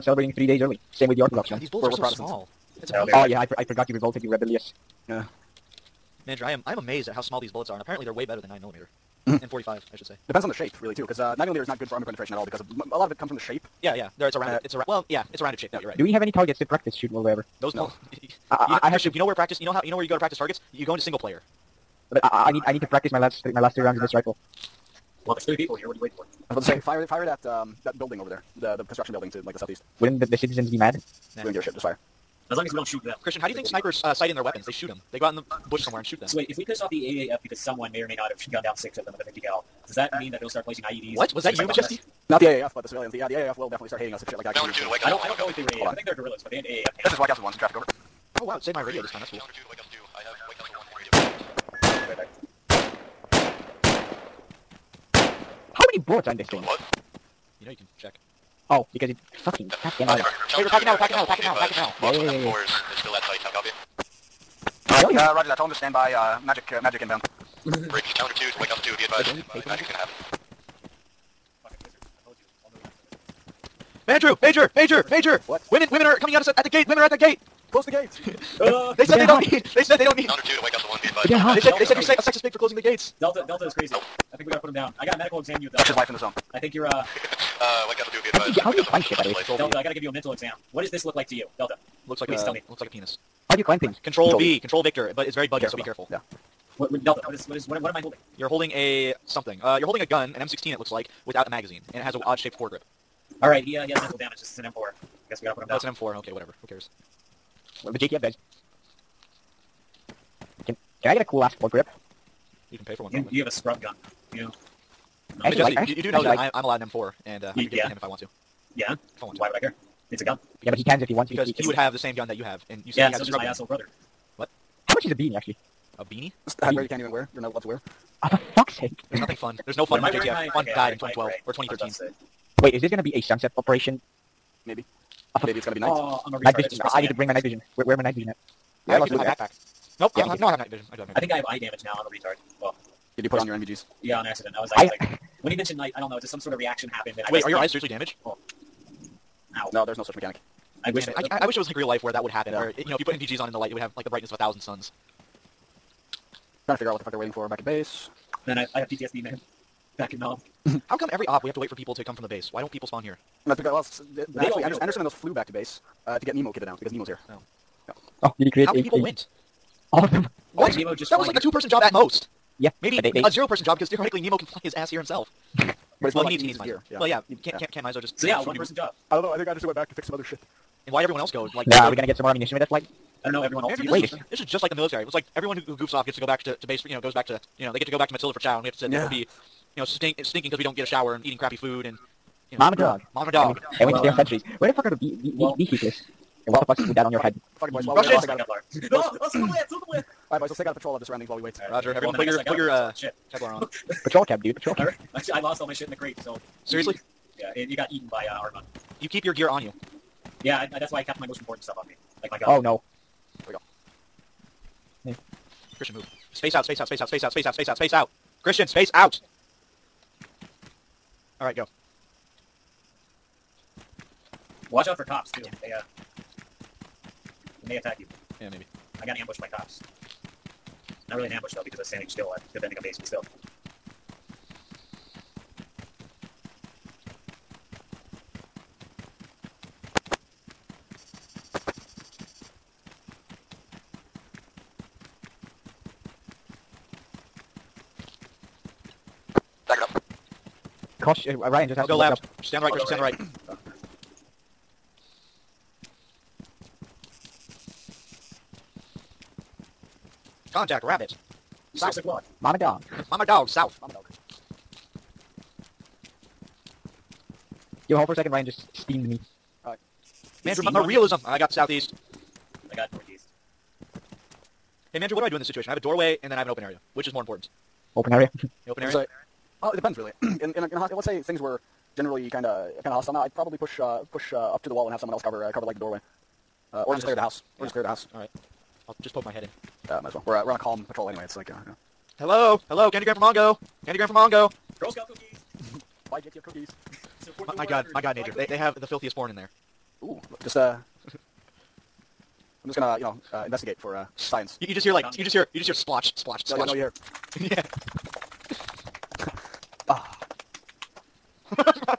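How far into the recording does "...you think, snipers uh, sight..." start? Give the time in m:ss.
0:33.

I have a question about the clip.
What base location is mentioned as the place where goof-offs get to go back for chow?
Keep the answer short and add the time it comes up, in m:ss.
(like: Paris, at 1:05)
Matilda, at 3:08.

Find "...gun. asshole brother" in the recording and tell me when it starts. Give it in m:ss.
2:03.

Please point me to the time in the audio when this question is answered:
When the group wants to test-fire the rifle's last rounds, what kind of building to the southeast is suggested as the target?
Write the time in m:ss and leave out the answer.
0:28.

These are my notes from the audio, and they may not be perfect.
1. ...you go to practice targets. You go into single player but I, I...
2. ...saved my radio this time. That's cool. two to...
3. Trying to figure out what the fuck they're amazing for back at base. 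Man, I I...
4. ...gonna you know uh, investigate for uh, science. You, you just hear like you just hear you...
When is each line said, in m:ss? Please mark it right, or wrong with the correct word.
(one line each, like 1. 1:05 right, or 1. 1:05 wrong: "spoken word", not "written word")
1. 0:20 right
2. 0:48 right
3. 2:36 wrong: "waiting", not "amazing"
4. 5:02 right.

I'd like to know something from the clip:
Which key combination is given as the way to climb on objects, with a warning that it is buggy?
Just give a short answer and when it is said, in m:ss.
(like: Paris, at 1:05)
Control V, at 1:34.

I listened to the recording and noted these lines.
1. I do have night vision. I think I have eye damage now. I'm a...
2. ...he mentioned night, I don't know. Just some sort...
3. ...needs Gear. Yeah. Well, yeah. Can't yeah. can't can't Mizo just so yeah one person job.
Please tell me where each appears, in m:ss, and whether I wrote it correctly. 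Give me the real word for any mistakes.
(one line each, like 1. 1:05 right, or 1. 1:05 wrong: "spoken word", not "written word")
1. 2:20 right
2. 2:25 right
3. 2:56 right.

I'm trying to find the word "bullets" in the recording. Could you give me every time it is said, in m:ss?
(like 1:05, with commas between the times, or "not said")
0:01, 0:07, 0:55.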